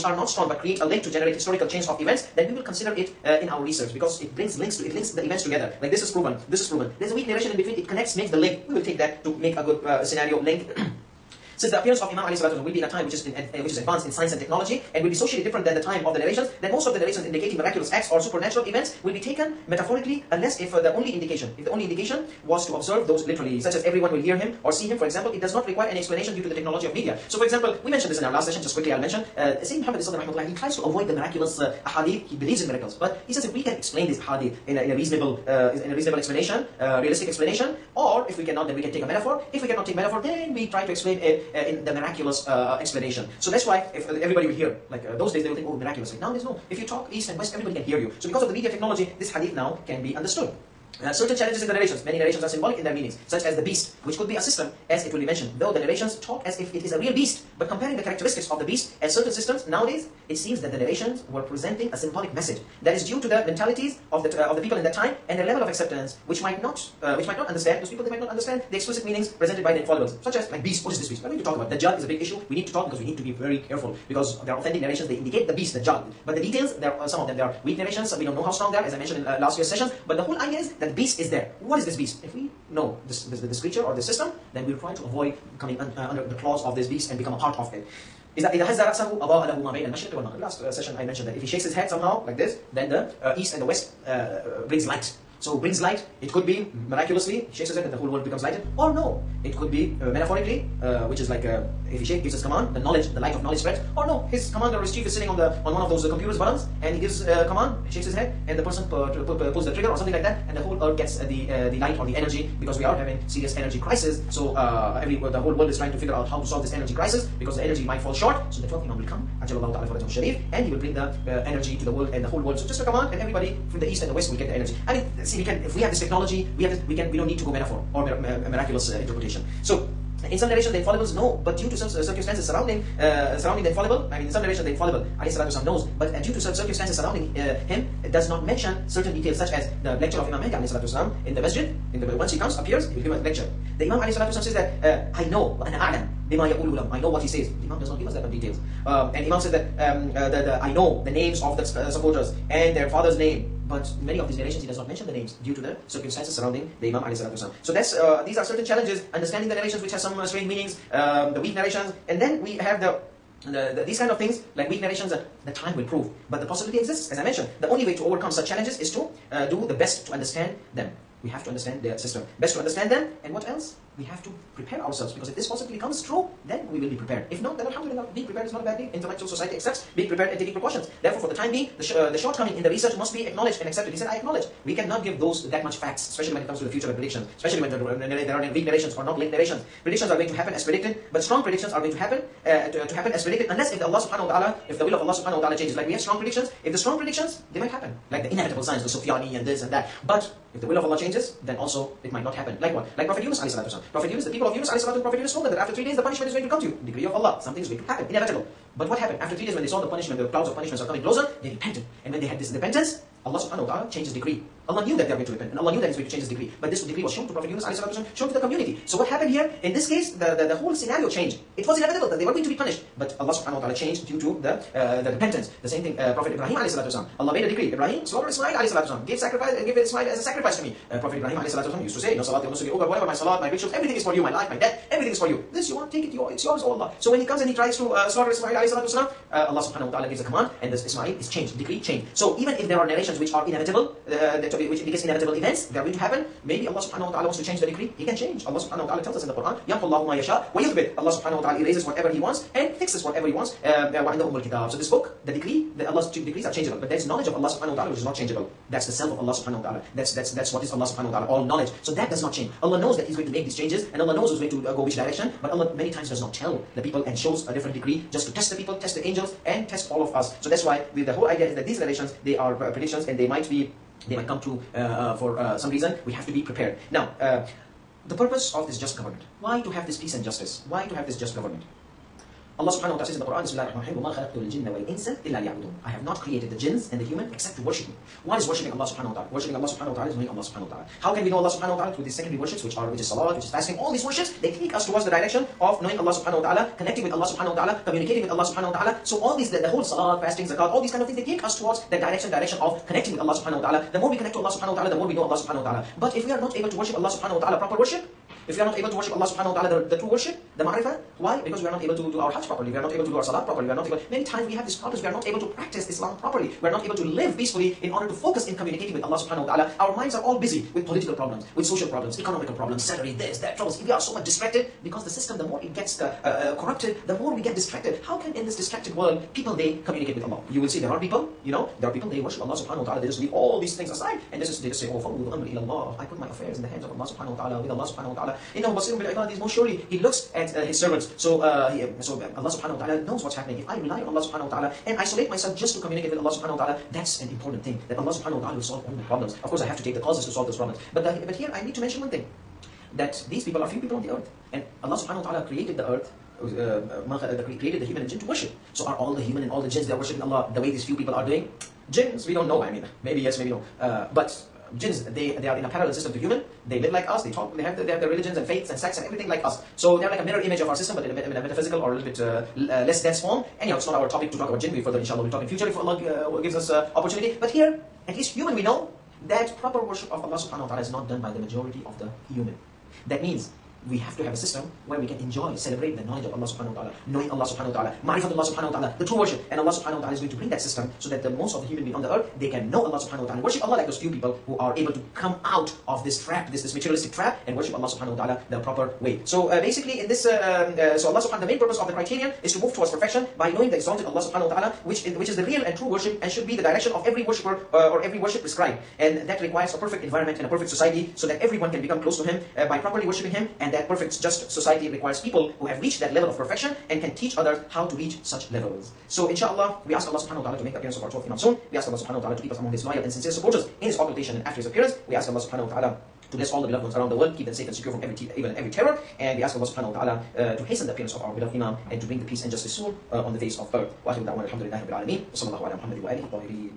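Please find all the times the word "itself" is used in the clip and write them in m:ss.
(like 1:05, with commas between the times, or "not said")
not said.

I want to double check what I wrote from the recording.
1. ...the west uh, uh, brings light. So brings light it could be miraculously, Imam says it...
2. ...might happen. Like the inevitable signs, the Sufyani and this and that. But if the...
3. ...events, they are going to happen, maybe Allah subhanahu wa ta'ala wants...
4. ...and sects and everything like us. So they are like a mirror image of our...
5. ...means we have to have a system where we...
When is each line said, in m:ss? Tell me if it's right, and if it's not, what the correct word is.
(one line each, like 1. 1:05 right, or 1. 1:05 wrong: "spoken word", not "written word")
1. 1:33 wrong: "Sheikh", not "Imam"
2. 3:17 right
3. 4:05 right
4. 6:08 right
5. 6:23 right.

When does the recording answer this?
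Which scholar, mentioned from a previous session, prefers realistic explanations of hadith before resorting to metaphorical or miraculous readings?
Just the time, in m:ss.
0:29.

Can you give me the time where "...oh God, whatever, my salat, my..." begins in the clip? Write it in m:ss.
3:52.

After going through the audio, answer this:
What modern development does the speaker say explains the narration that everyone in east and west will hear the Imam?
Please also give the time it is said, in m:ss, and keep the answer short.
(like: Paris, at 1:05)
media technology, at 0:48.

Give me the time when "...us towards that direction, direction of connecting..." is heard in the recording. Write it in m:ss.
5:01.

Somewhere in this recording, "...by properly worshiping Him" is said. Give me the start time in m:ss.
6:52.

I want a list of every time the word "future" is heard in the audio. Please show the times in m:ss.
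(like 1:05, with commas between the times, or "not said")
3:06, 6:15.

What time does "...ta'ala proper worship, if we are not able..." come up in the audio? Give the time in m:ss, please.
5:07.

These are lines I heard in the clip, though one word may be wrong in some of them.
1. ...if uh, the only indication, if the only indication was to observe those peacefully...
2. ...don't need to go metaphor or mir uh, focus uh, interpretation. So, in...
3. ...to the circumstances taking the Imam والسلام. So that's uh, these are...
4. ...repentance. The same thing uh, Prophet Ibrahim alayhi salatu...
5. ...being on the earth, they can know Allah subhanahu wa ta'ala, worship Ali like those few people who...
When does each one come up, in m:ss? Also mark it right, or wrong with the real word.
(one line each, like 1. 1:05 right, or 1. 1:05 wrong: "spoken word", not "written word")
1. 0:20 wrong: "literally", not "peacefully"
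2. 2:07 wrong: "miraculous", not "focus"
3. 2:35 wrong: "surrounding", not "taking"
4. 3:45 right
5. 6:31 wrong: "Allah", not "Ali".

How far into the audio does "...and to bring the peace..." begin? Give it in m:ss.
7:11.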